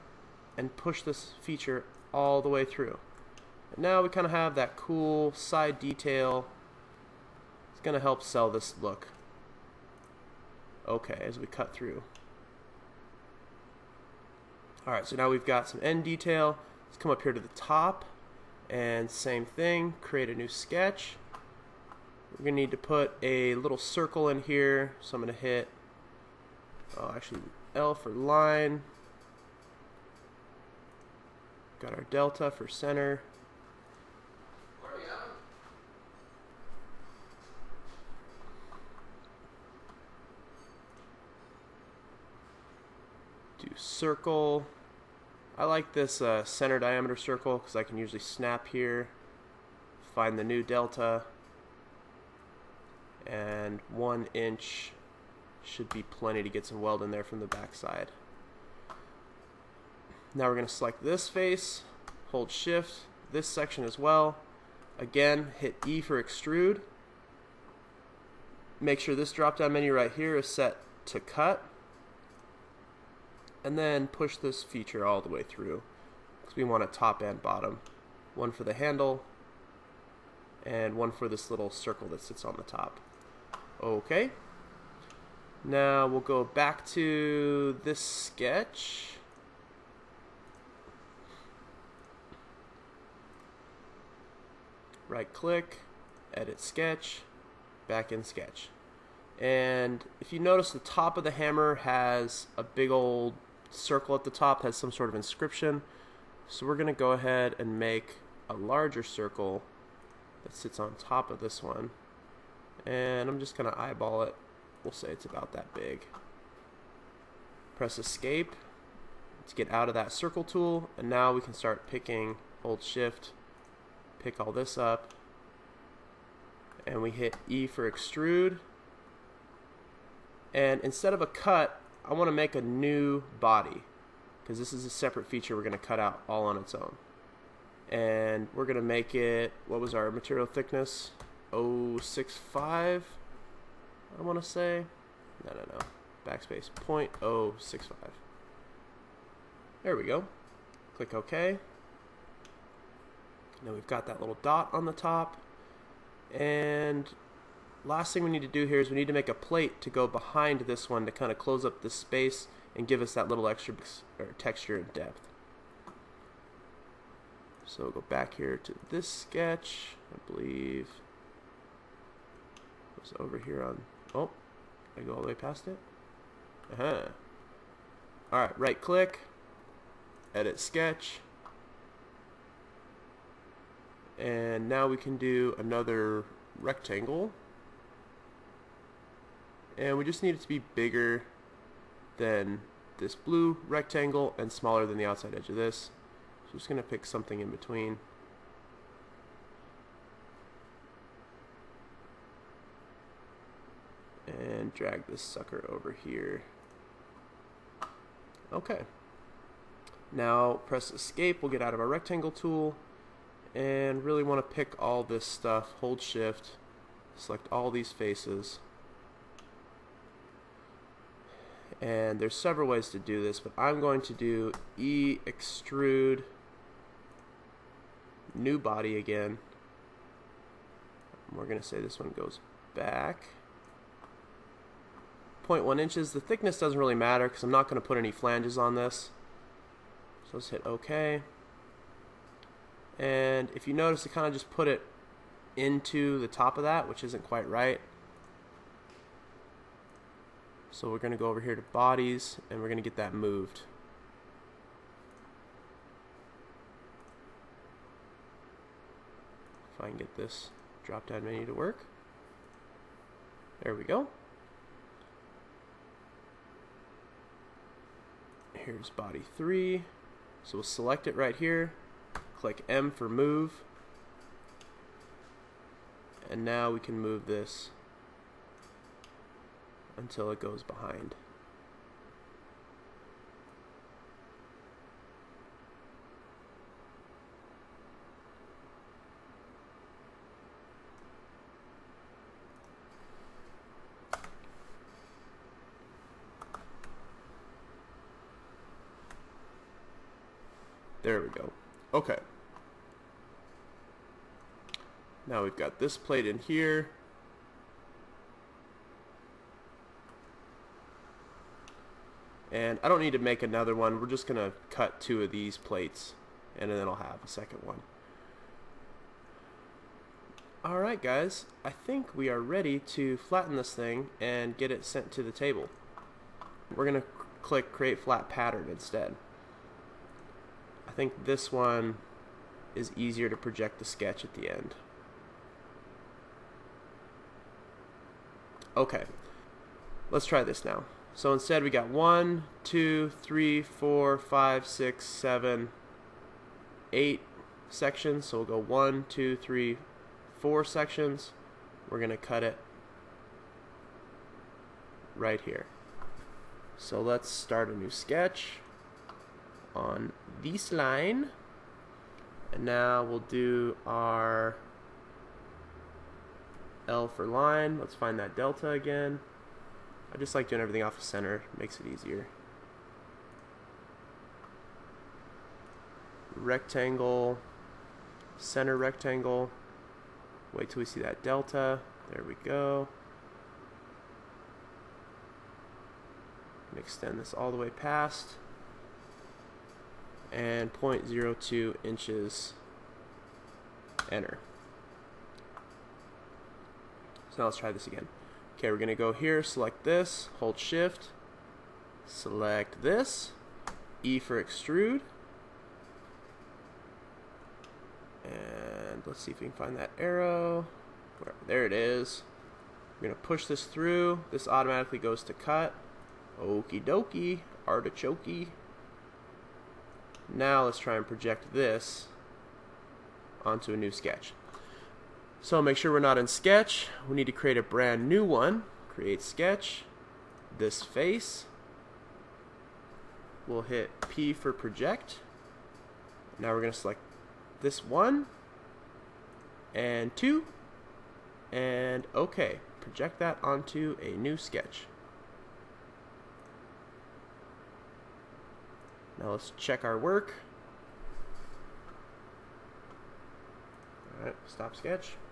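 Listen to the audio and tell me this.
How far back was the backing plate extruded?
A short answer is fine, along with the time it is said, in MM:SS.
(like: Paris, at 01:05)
0.1 inches, at 03:55.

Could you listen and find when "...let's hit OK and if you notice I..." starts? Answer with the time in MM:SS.
04:00.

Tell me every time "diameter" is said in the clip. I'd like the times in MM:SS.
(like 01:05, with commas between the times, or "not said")
00:46.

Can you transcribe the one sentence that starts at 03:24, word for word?
And drag this sucker over here.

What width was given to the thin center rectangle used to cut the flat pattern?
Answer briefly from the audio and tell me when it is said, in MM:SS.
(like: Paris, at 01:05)
0.02 inches, at 06:30.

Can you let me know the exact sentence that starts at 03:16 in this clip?
So I'm just going to pick something in between.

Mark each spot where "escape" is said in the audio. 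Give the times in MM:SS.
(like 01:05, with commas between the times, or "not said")
01:57, 03:30.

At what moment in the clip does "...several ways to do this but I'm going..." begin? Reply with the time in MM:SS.
03:42.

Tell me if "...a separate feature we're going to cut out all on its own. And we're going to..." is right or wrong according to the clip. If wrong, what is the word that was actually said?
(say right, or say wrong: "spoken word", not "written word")
right.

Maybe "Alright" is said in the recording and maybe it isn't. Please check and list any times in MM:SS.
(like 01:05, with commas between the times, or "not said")
05:20, 07:34.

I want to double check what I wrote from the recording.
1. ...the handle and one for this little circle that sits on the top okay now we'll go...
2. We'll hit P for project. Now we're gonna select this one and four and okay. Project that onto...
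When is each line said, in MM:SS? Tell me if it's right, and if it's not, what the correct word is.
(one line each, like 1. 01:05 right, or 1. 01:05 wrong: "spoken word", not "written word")
1. 01:18 right
2. 07:13 wrong: "two", not "four".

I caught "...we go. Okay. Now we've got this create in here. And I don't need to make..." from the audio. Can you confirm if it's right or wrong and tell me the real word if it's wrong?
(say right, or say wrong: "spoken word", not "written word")
wrong: "plate", not "create".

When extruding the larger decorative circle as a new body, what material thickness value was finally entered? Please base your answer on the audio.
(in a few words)
0.065.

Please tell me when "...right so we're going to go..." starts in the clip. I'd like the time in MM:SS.
04:07.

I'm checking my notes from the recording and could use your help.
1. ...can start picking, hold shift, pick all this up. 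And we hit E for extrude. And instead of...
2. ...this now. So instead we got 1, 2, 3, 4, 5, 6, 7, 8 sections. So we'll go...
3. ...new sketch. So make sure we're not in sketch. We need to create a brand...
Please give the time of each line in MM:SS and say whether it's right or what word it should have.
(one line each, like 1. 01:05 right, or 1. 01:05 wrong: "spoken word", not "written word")
1. 02:01 right
2. 05:40 right
3. 07:03 right.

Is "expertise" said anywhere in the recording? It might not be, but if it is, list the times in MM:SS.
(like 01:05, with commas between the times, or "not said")
not said.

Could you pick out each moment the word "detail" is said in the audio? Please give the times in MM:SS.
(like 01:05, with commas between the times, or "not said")
00:05, 00:16.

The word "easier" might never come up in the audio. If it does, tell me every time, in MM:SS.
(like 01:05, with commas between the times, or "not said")
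05:32, 06:11.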